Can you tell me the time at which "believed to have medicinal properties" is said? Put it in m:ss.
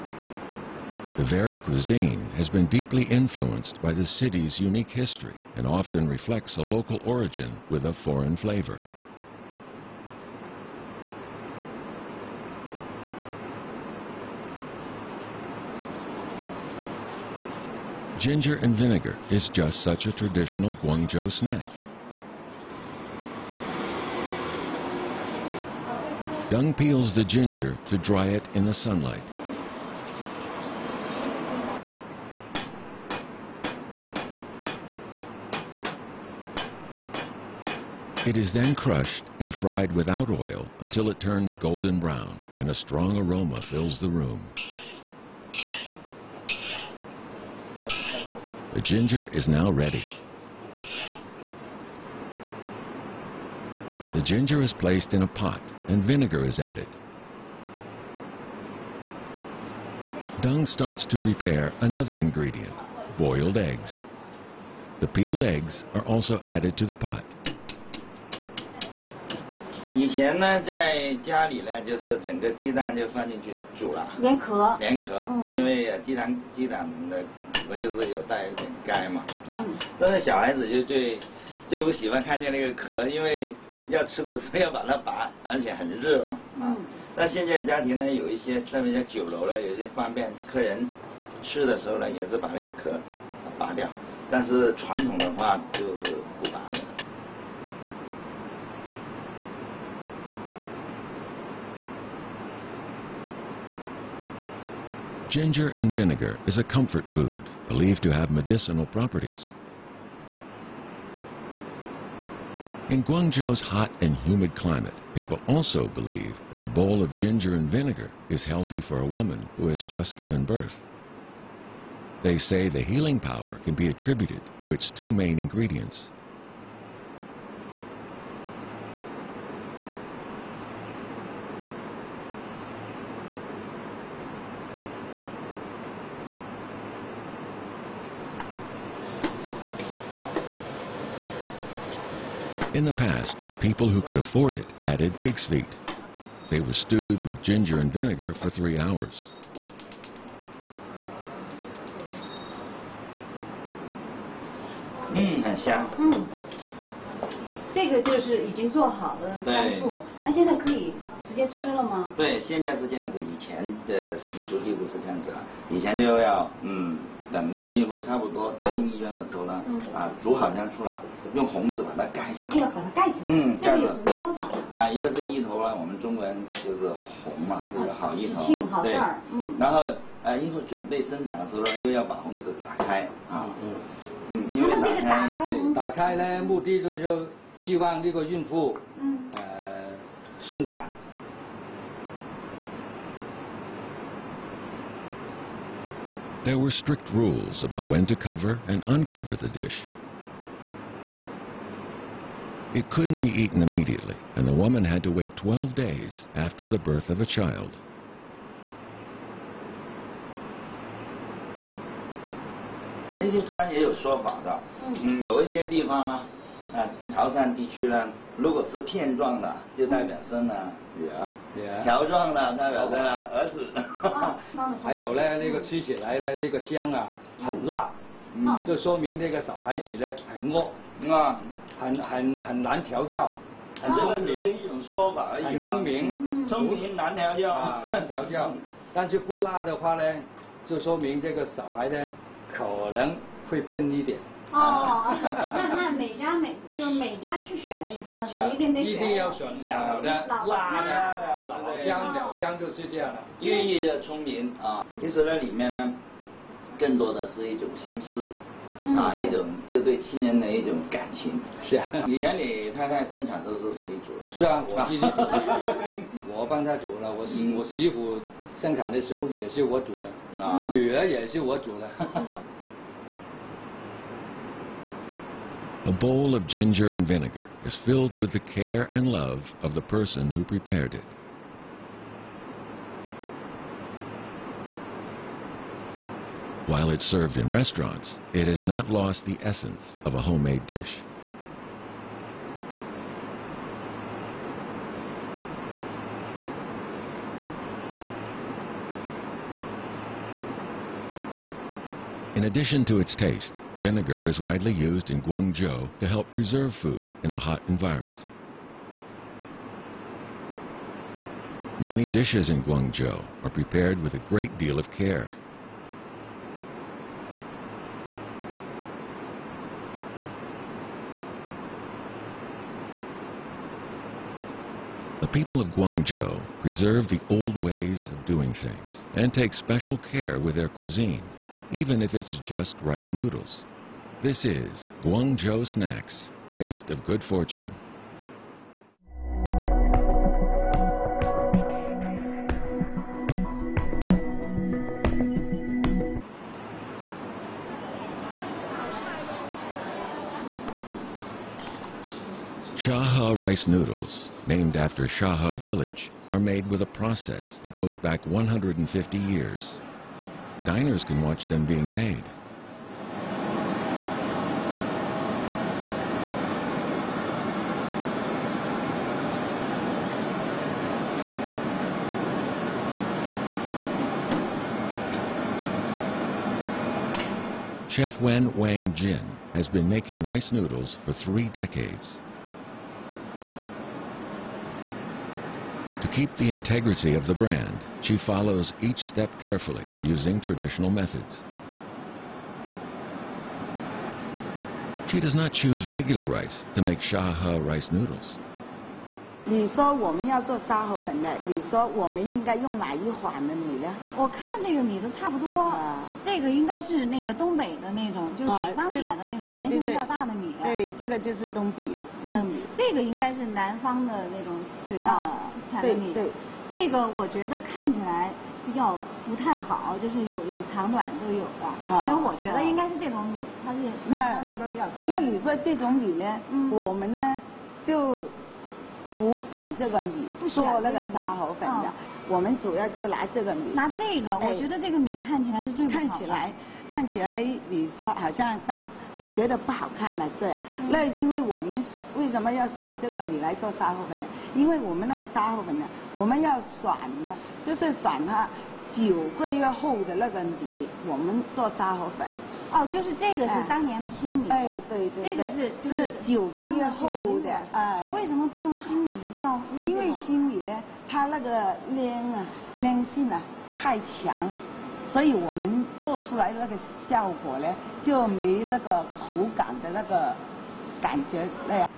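1:47.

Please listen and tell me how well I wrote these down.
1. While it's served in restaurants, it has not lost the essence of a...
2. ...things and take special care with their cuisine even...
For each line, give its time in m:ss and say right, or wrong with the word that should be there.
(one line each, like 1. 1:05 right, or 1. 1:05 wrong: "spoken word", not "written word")
1. 4:46 right
2. 5:28 right.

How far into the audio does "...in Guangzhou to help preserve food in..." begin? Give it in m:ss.
5:05.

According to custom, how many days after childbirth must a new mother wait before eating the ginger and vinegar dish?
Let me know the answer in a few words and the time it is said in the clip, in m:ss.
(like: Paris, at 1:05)
12, at 3:25.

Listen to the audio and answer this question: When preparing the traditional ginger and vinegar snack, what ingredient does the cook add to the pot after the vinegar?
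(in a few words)
Boiled eggs.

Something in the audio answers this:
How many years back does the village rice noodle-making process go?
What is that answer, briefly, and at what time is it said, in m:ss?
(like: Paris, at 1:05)
150, at 5:58.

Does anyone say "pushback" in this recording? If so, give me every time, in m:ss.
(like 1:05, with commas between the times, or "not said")
not said.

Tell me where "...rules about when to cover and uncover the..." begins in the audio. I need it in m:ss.
3:17.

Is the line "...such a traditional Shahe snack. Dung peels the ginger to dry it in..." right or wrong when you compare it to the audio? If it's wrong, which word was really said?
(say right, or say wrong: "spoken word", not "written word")
wrong: "Guangzhou", not "Shahe".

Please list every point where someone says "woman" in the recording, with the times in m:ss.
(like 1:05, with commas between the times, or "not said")
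1:59, 3:24.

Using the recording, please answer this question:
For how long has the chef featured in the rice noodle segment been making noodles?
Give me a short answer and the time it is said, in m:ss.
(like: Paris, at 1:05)
Three decades, at 6:21.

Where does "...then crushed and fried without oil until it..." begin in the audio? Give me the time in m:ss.
0:38.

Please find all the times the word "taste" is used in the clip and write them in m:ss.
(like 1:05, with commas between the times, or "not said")
5:03, 5:36.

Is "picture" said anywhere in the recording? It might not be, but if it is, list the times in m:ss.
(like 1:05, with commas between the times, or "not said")
not said.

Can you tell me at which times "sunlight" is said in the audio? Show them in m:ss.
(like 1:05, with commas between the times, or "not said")
0:28.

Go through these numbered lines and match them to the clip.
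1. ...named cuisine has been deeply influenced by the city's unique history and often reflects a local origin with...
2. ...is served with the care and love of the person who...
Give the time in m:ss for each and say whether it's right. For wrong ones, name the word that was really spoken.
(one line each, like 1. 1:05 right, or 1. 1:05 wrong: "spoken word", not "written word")
1. 0:01 wrong: "varied", not "named"
2. 4:37 wrong: "filled", not "served".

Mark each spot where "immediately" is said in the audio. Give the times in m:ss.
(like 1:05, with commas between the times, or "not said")
3:23.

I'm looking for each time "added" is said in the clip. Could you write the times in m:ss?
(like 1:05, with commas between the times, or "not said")
0:56, 1:06.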